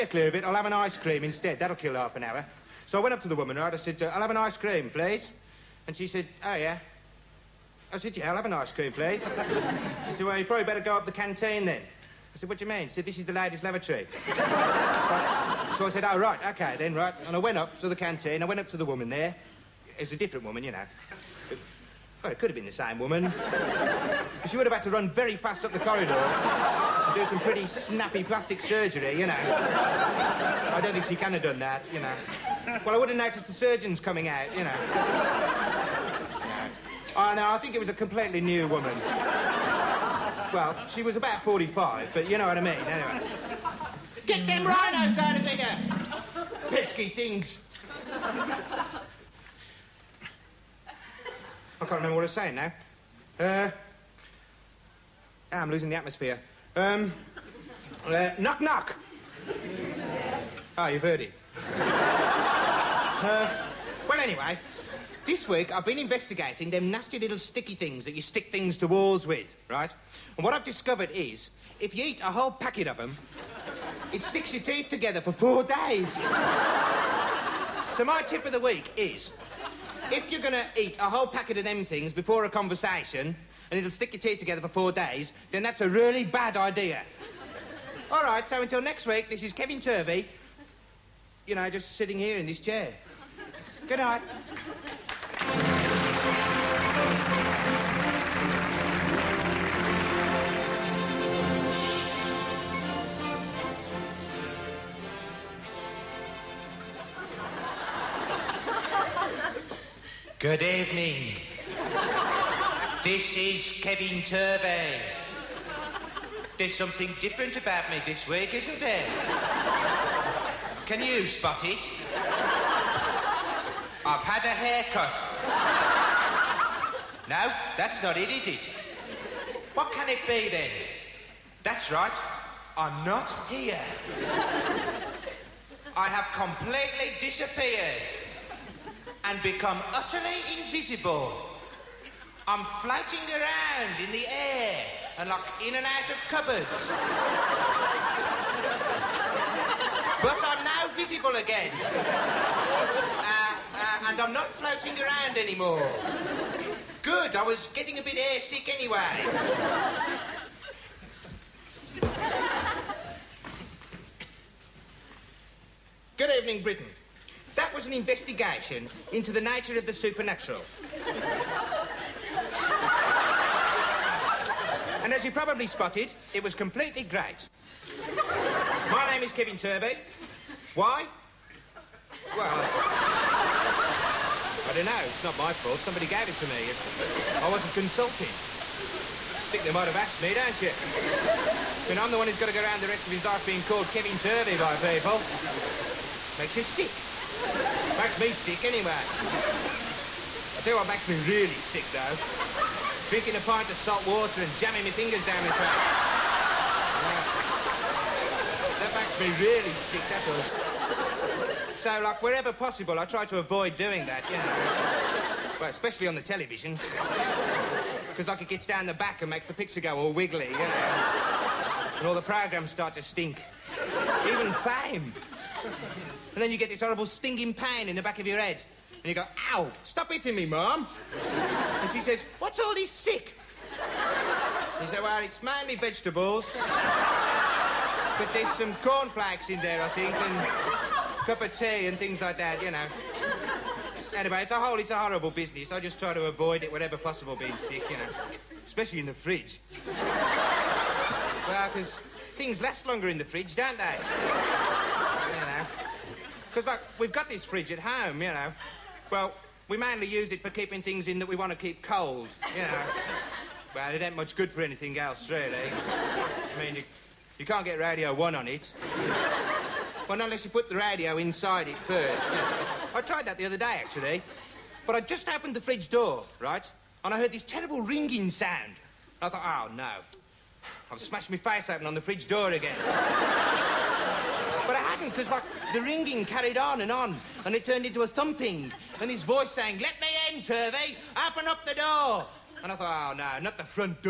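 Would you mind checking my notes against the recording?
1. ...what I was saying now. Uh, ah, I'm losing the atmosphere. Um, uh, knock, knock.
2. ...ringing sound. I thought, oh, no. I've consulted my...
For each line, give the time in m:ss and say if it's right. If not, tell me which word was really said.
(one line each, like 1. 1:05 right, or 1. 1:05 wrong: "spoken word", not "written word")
1. 0:52 right
2. 4:37 wrong: "smashed", not "consulted".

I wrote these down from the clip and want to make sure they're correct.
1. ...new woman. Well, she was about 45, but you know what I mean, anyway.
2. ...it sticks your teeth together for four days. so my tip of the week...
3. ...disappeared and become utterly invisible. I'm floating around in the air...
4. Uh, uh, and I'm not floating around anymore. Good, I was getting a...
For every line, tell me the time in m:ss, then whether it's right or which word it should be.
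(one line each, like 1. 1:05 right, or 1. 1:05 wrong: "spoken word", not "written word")
1. 0:38 right
2. 1:14 right
3. 2:17 right
4. 2:31 right.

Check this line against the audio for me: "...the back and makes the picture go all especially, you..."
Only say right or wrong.
wrong.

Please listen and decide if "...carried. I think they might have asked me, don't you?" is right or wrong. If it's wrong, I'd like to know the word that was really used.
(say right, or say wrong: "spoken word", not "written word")
wrong: "consulted", not "carried".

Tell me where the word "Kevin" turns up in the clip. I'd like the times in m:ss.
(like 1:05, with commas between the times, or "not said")
1:29, 1:53, 2:59, 3:13.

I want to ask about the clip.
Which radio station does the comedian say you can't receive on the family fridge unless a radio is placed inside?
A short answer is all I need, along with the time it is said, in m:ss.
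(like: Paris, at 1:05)
Radio 1, at 4:27.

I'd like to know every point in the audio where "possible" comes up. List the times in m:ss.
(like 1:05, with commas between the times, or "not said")
3:32, 4:06.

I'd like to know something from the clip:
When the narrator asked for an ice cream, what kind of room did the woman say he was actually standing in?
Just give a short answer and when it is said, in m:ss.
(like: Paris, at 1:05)
ladies' lavatory, at 0:13.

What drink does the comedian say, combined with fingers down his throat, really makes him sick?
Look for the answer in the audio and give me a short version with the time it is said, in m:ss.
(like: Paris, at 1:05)
a pint of salt water, at 3:23.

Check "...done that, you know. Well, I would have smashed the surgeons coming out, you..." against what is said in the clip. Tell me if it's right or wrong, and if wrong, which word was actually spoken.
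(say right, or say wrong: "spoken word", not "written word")
wrong: "noticed", not "smashed".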